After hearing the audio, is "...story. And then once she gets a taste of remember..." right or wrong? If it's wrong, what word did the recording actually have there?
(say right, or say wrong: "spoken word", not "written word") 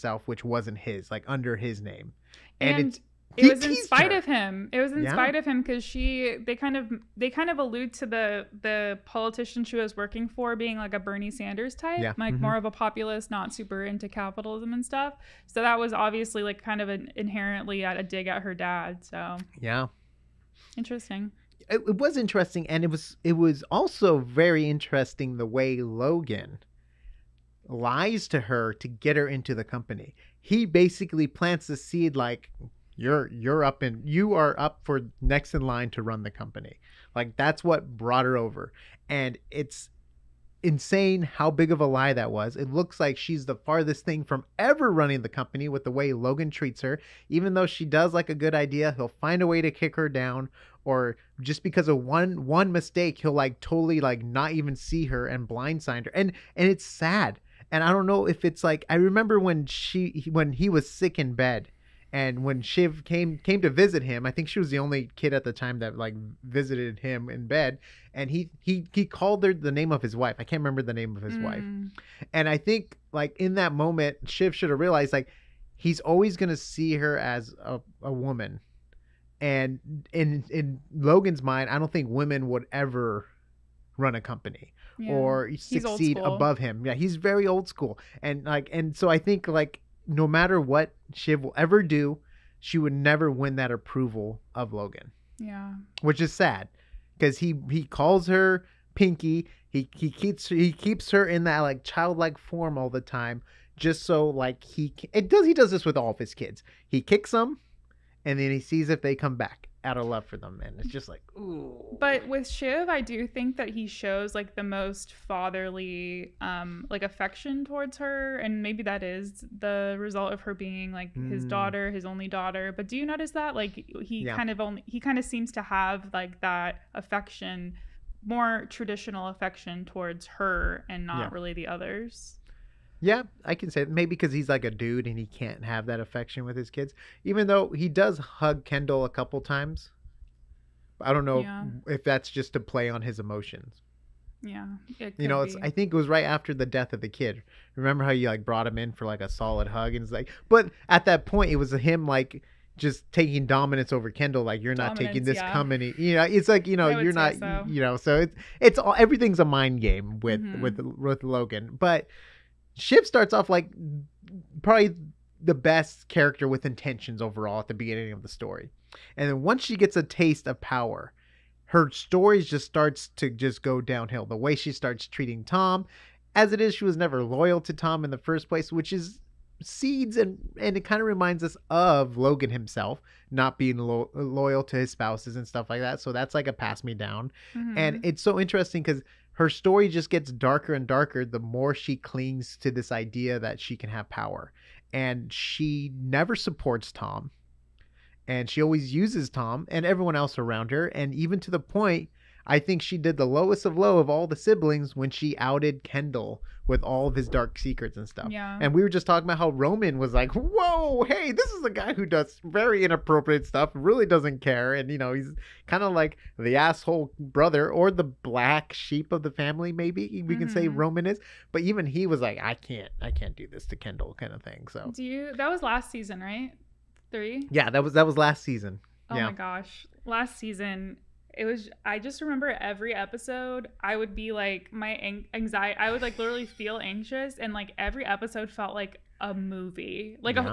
wrong: "power", not "remember".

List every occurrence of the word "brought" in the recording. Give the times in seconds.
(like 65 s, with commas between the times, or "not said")
37 s, 148 s.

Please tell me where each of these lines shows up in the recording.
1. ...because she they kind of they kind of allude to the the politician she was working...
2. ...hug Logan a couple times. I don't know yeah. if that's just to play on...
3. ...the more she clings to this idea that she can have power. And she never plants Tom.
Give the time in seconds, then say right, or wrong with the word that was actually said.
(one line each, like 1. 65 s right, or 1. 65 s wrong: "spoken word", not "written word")
1. 5 s right
2. 138 s wrong: "Kendall", not "Logan"
3. 191 s wrong: "supports", not "plants".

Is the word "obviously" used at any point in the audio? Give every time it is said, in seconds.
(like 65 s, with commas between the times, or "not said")
15 s.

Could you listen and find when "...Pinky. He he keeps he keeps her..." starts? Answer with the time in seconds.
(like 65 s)
98 s.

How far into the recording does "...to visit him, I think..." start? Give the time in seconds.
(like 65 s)
63 s.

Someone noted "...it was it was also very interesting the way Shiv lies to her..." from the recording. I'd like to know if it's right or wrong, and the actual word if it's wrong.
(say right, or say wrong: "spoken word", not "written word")
wrong: "Logan", not "Shiv".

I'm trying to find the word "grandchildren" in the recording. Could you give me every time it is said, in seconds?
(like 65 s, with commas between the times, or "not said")
not said.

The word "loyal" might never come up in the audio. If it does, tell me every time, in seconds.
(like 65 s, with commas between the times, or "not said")
177 s, 184 s.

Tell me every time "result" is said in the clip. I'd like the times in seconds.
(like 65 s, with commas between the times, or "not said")
119 s.